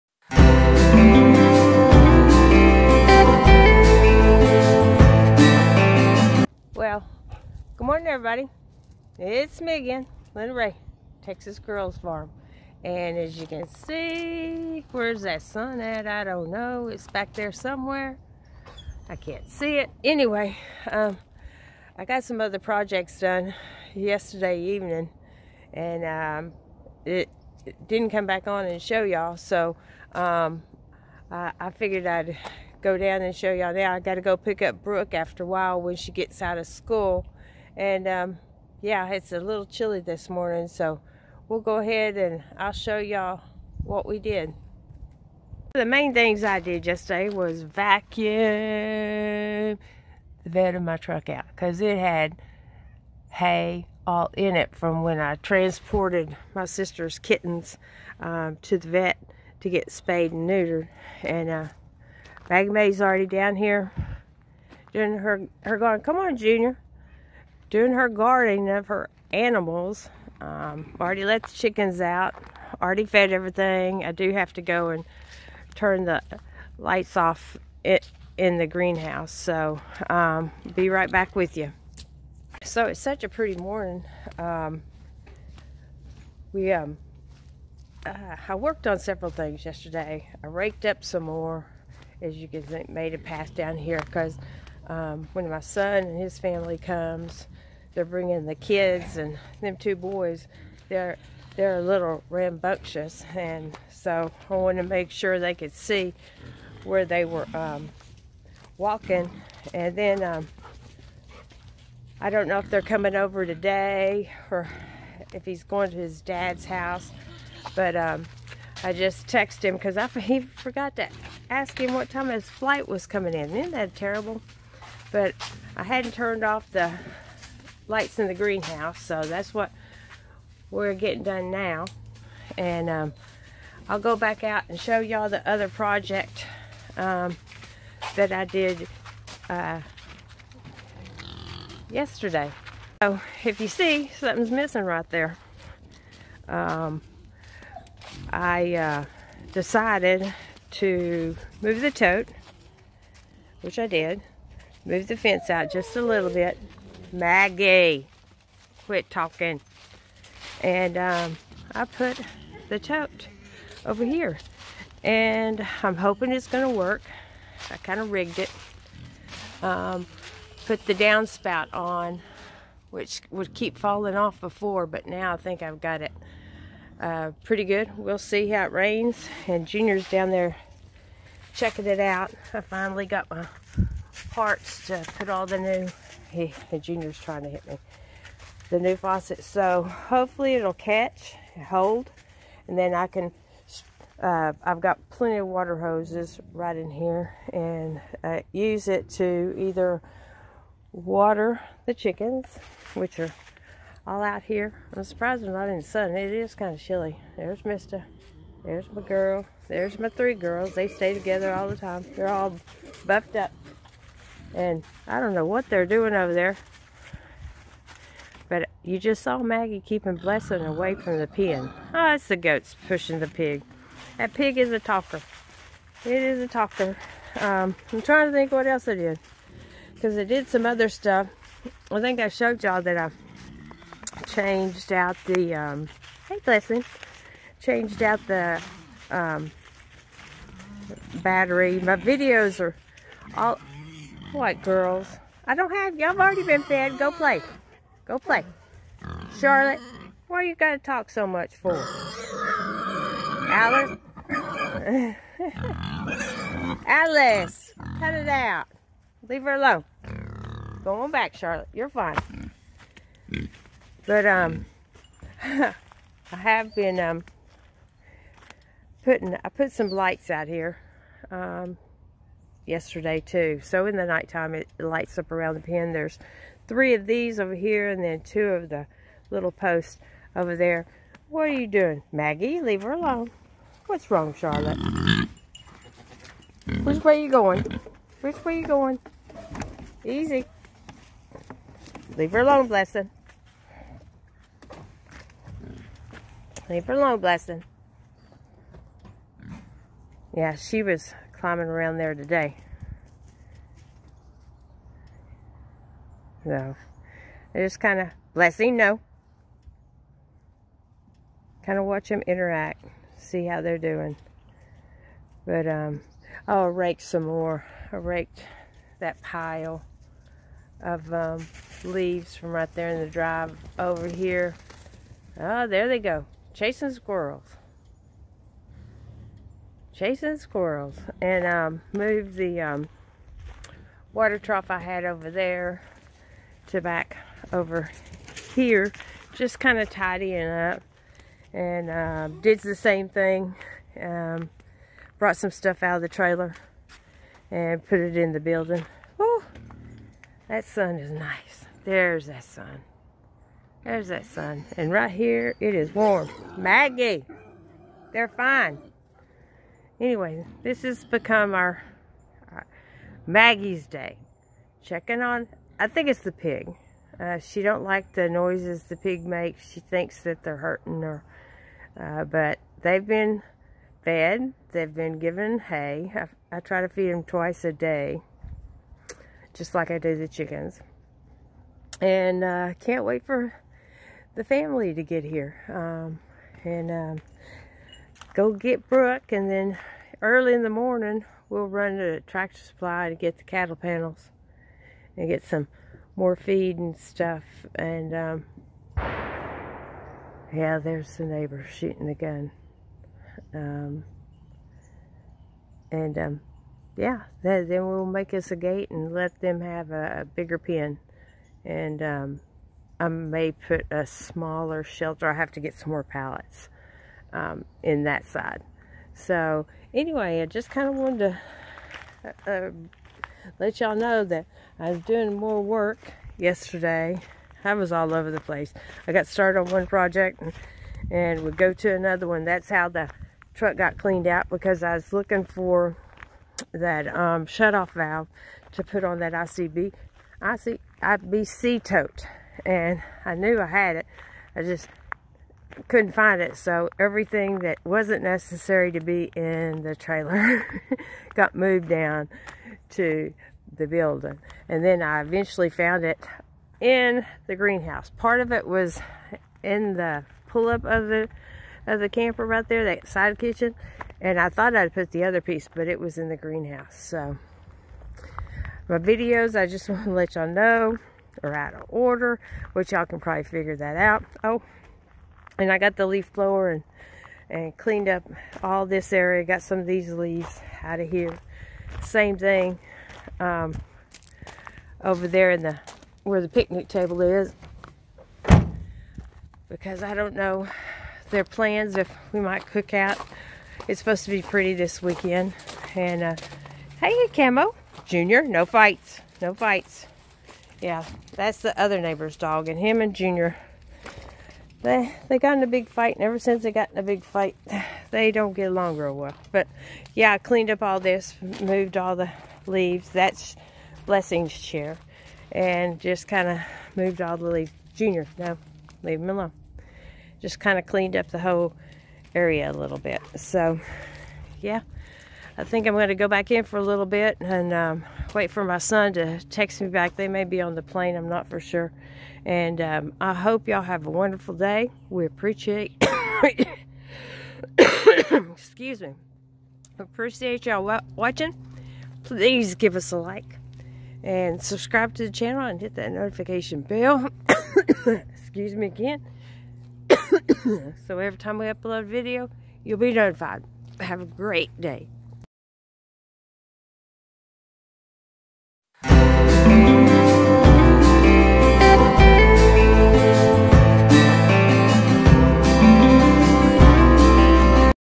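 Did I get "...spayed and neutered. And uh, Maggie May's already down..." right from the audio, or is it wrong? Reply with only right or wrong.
right.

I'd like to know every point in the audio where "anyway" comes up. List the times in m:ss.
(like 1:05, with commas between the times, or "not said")
0:20, 6:00, 6:59.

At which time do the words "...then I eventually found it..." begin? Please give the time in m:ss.
7:34.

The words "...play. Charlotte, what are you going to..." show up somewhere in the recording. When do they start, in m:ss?
4:08.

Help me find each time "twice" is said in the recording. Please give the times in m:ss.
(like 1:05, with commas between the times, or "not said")
6:17.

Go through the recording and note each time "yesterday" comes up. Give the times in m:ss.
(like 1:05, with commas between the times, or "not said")
0:23, 0:46, 1:29, 2:21, 4:32, 7:06.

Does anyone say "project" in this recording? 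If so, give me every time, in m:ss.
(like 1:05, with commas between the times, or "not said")
0:22, 2:15, 7:09.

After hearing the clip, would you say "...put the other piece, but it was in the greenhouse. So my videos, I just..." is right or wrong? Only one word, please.
right.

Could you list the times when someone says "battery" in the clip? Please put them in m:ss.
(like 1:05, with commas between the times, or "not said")
4:01.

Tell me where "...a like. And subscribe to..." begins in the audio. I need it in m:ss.
9:03.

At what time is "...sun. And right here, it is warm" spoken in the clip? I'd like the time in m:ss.
5:54.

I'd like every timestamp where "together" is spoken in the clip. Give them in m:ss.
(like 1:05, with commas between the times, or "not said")
3:31.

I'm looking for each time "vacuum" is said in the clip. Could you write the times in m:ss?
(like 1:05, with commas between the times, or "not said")
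0:47.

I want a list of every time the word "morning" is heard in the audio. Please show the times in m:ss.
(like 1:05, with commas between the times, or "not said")
0:40, 1:23, 6:30.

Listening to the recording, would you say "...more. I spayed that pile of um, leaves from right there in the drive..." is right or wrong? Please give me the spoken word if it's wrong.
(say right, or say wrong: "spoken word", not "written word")
wrong: "raked", not "spayed".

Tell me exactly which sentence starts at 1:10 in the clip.
Um, already let the chickens out.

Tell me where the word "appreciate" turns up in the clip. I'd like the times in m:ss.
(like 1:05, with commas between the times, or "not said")
8:55, 8:59.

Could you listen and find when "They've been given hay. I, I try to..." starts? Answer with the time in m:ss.
6:14.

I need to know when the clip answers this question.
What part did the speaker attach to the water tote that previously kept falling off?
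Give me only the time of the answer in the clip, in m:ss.
2:50.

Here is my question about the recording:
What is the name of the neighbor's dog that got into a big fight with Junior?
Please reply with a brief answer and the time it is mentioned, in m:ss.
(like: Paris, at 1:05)
Camo, at 8:17.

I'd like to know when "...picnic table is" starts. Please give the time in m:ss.
8:06.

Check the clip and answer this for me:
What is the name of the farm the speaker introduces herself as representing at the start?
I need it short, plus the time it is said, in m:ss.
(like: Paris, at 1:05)
Texas Girls Farm, at 0:11.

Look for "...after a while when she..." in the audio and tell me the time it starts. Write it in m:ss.
0:35.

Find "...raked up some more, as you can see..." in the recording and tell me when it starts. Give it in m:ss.
1:30.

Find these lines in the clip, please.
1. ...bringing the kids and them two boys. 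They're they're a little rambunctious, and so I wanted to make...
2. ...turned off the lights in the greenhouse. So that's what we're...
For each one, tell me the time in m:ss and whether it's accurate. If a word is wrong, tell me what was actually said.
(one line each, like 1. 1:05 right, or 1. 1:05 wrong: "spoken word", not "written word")
1. 1:38 right
2. 2:06 right.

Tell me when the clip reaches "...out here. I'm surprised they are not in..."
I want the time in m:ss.
3:24.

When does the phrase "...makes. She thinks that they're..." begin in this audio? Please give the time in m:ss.
6:09.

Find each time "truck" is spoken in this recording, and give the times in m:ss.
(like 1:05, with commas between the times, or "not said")
0:50, 7:13.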